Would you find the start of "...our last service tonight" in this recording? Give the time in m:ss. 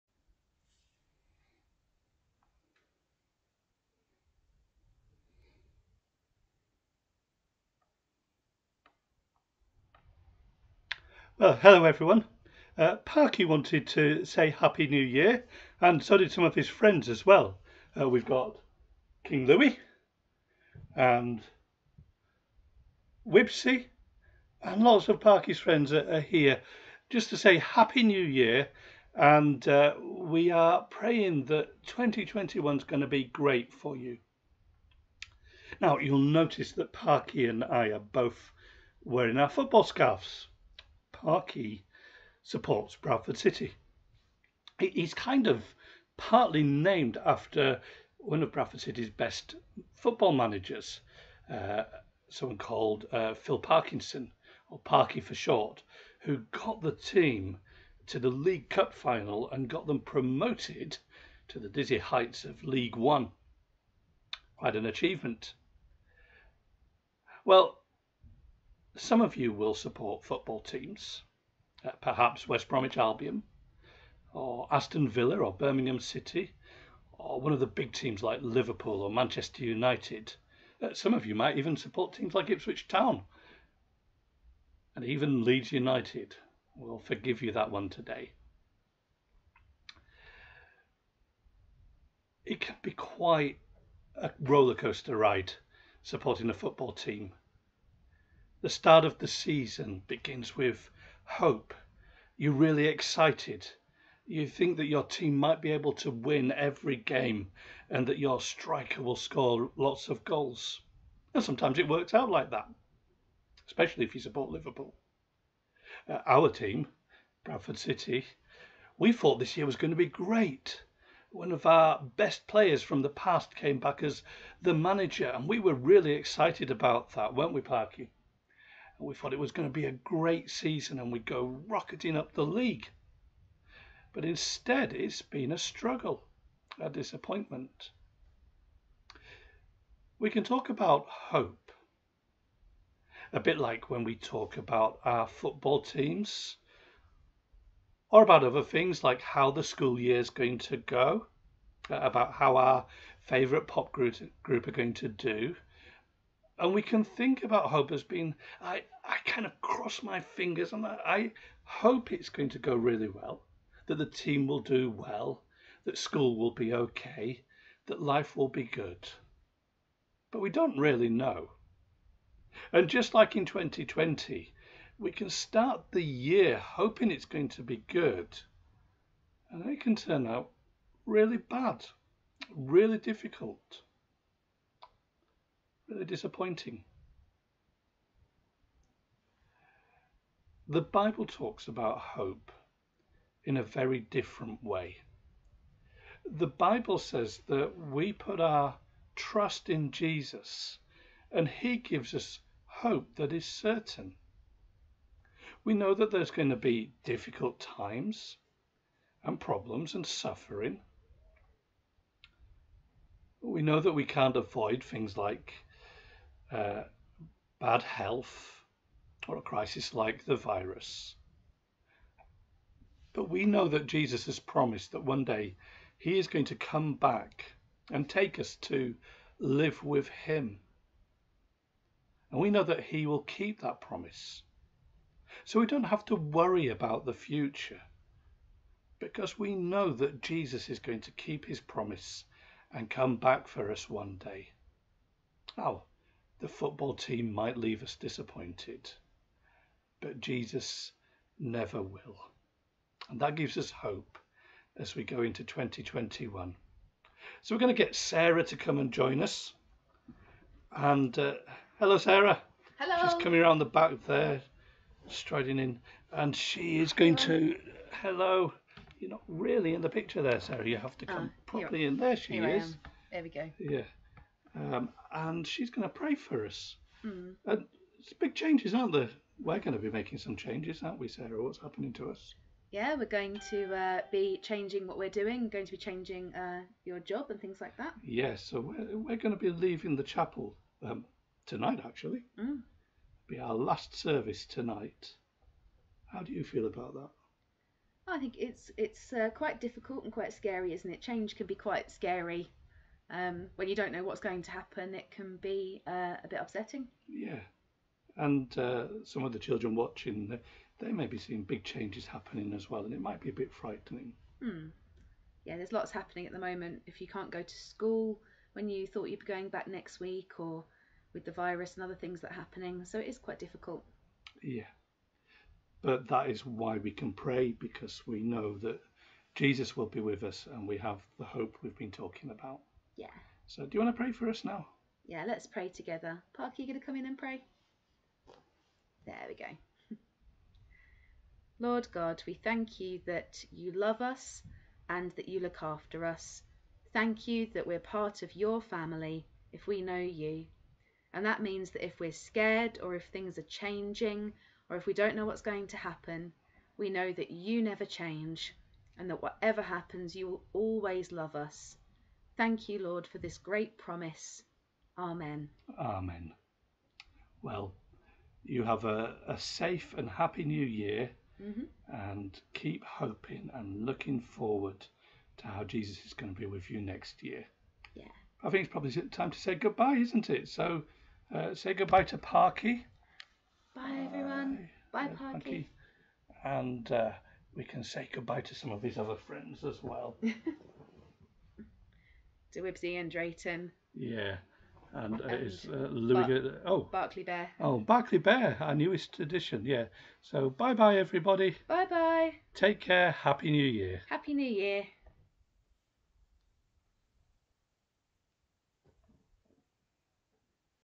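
4:53.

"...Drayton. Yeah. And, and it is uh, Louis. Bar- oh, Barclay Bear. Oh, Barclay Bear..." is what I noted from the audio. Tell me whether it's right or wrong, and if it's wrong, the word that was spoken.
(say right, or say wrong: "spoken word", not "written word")
right.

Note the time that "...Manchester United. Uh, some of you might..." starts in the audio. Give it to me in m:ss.
1:19.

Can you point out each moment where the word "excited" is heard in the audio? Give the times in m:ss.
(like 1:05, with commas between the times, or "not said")
1:42, 2:06.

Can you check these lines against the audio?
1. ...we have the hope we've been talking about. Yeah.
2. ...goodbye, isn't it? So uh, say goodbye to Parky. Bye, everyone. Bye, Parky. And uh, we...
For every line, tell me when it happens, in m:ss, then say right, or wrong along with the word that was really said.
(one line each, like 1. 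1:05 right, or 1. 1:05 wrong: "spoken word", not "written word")
1. 5:30 right
2. 6:19 right.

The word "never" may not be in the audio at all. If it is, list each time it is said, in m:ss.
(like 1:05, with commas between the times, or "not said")
4:11, 5:57.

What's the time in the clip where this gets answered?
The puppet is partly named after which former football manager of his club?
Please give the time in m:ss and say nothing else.
0:53.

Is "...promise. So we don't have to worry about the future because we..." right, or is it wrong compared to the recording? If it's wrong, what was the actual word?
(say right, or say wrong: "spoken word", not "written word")
right.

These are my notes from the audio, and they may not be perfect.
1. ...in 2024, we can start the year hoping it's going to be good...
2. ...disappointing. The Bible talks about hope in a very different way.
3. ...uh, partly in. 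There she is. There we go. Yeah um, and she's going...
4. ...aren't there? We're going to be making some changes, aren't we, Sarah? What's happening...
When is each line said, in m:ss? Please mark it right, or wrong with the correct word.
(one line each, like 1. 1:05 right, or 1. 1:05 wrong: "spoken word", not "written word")
1. 2:53 wrong: "2020", not "2024"
2. 3:06 right
3. 4:31 wrong: "properly", not "partly"
4. 4:38 right.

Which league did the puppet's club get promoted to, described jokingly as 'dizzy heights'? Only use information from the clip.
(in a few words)
League One.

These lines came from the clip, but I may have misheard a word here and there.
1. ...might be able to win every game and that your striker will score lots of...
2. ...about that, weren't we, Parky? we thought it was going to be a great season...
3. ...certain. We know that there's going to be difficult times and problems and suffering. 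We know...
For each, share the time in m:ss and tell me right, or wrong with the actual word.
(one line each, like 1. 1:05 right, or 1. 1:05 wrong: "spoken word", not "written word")
1. 1:45 right
2. 2:06 right
3. 3:23 right.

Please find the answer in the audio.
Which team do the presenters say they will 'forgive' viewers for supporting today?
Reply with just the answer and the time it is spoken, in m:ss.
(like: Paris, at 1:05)
Leeds United, at 1:25.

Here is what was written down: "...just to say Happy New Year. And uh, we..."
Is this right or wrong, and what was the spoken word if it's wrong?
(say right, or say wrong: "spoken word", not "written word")
right.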